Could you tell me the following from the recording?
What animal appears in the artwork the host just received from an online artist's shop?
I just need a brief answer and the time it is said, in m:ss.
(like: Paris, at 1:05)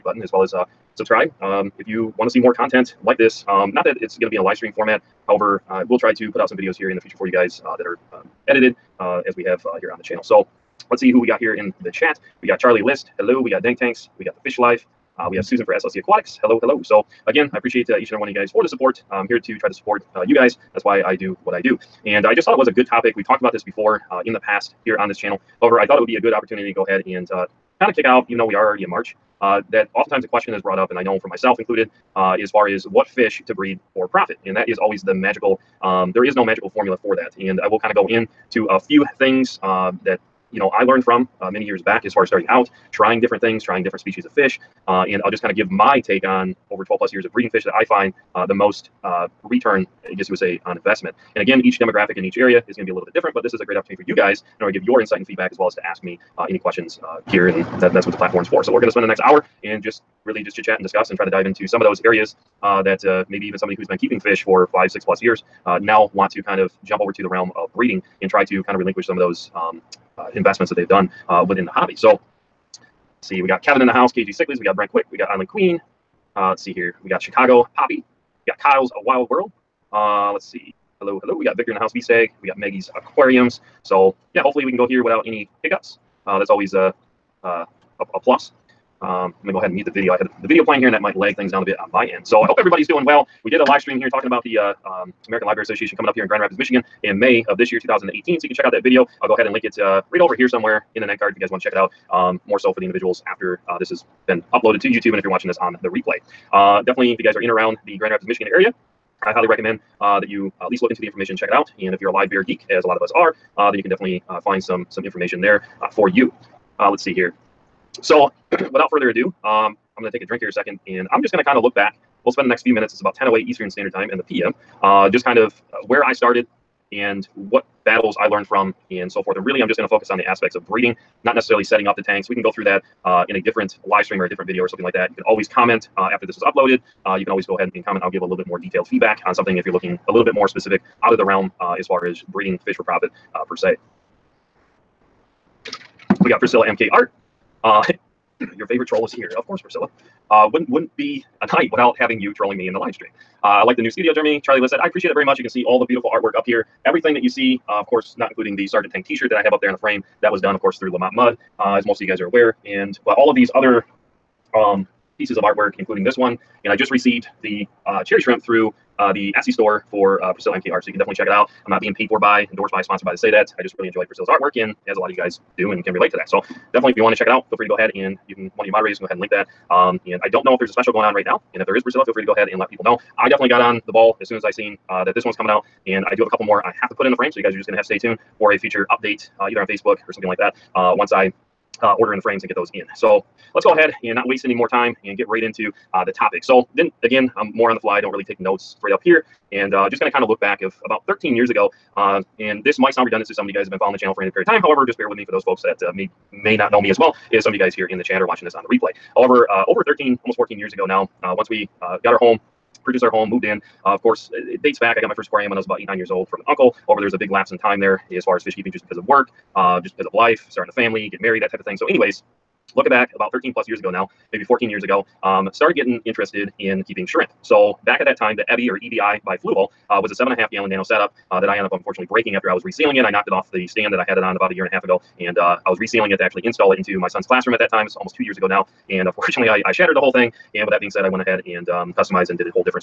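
cherry shrimp, at 2:48.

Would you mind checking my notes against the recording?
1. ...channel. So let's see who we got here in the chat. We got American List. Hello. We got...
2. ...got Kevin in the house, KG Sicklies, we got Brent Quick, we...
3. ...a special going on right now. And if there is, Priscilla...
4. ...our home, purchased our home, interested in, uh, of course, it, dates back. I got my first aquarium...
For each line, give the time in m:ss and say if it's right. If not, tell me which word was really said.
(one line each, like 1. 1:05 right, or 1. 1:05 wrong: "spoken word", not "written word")
1. 0:10 wrong: "Charlie", not "American"
2. 1:13 right
3. 3:00 right
4. 3:32 wrong: "moved", not "interested".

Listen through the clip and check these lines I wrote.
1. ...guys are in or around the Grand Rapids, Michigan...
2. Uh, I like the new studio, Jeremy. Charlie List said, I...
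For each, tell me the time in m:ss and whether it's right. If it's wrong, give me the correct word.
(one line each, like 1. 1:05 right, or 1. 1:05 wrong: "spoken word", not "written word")
1. 1:47 right
2. 2:33 right.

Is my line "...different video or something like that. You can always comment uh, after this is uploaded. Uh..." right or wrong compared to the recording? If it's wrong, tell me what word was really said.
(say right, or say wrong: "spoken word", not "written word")
right.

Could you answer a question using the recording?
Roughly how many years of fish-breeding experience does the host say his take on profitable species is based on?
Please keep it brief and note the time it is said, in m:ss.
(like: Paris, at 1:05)
12 plus years, at 0:46.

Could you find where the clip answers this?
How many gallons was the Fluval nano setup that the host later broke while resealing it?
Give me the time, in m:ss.
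3:50.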